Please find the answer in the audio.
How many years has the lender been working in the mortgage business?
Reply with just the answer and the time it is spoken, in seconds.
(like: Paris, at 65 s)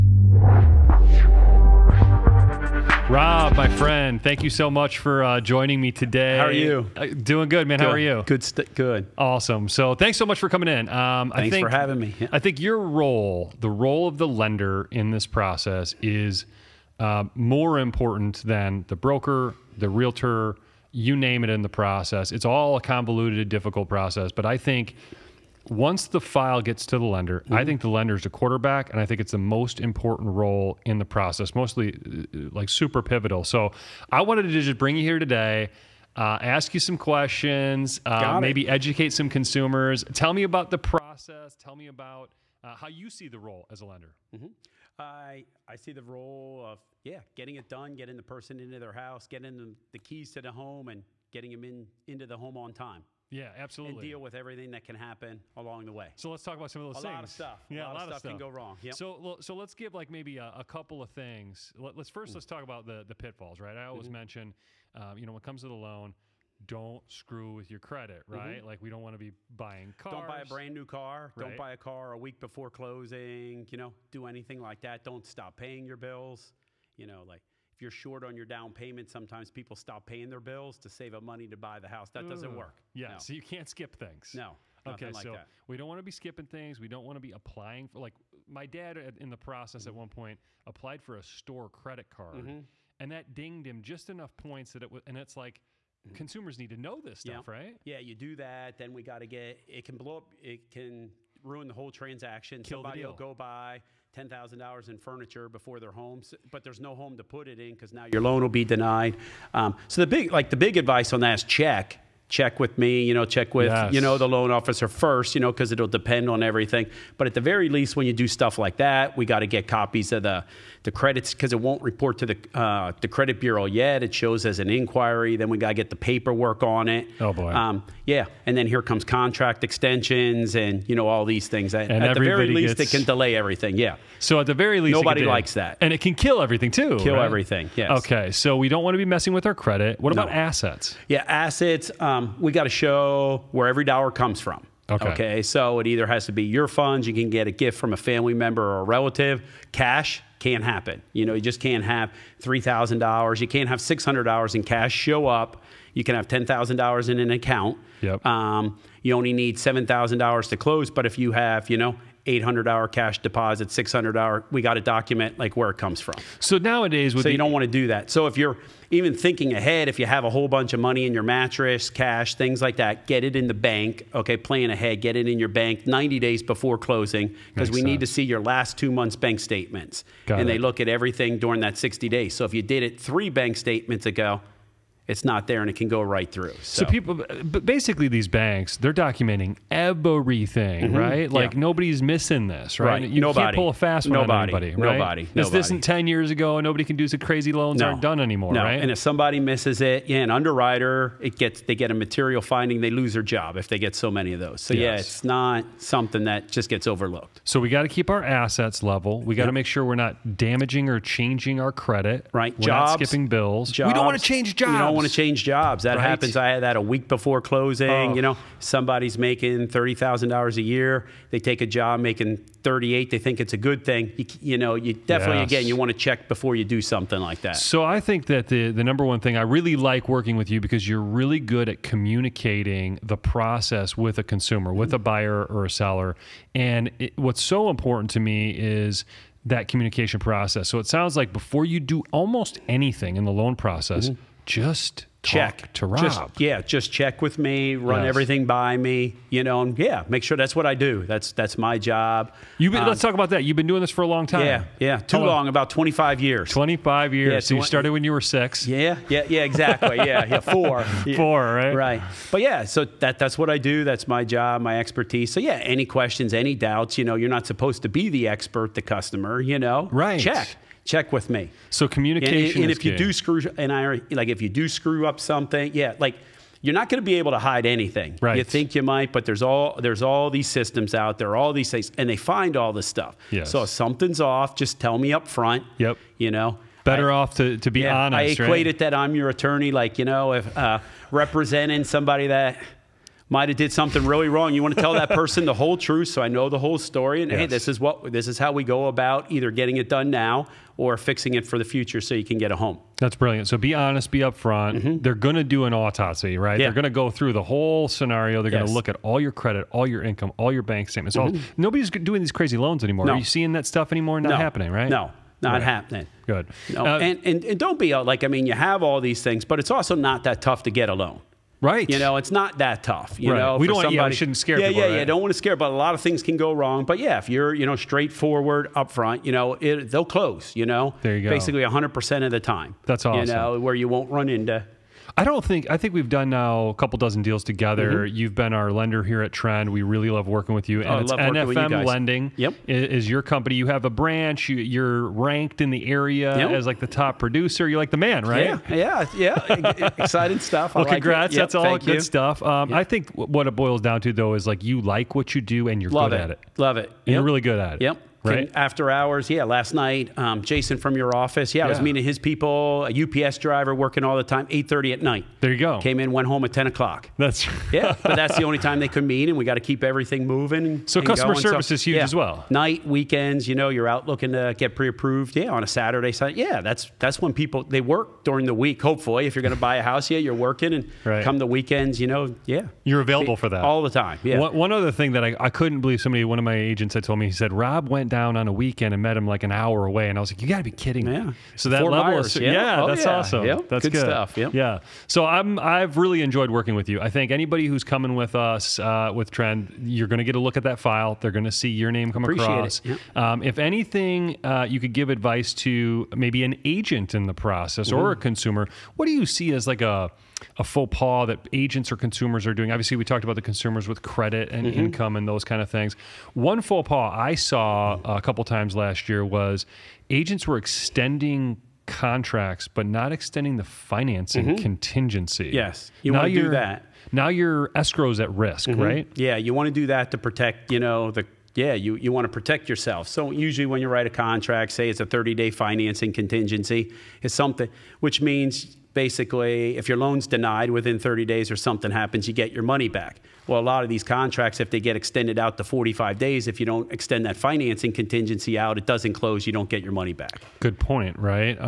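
25, at 255 s.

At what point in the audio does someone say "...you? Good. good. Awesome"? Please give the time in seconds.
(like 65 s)
7 s.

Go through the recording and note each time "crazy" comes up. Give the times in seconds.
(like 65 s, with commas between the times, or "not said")
197 s, 312 s.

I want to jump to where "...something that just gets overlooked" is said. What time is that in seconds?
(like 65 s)
205 s.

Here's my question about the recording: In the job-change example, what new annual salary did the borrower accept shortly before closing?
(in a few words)
$38,000.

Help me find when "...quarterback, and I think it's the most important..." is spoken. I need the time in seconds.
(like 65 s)
28 s.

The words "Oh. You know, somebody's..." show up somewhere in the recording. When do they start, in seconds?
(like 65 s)
217 s.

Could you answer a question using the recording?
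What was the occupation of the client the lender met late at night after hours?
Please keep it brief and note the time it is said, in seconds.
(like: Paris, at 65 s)
UPS driver, at 362 s.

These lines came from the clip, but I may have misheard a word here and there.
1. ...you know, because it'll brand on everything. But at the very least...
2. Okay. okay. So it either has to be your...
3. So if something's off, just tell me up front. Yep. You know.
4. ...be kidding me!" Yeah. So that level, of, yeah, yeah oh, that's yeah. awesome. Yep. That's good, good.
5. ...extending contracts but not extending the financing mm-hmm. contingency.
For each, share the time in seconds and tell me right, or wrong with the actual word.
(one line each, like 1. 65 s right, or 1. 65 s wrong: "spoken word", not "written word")
1. 115 s wrong: "depend", not "brand"
2. 144 s right
3. 283 s right
4. 390 s right
5. 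420 s right.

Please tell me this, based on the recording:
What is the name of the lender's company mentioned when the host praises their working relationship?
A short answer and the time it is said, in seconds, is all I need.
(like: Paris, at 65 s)
NFM Lending, at 341 s.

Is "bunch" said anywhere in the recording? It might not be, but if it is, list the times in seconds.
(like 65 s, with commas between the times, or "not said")
170 s.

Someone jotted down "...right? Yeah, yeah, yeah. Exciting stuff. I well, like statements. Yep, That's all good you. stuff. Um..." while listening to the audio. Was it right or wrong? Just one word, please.
wrong.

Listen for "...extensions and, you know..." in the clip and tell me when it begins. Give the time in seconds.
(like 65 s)
129 s.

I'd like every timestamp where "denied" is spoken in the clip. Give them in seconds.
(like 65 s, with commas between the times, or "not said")
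108 s, 440 s.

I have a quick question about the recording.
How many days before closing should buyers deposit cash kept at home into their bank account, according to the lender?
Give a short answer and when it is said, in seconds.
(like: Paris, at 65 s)
90, at 175 s.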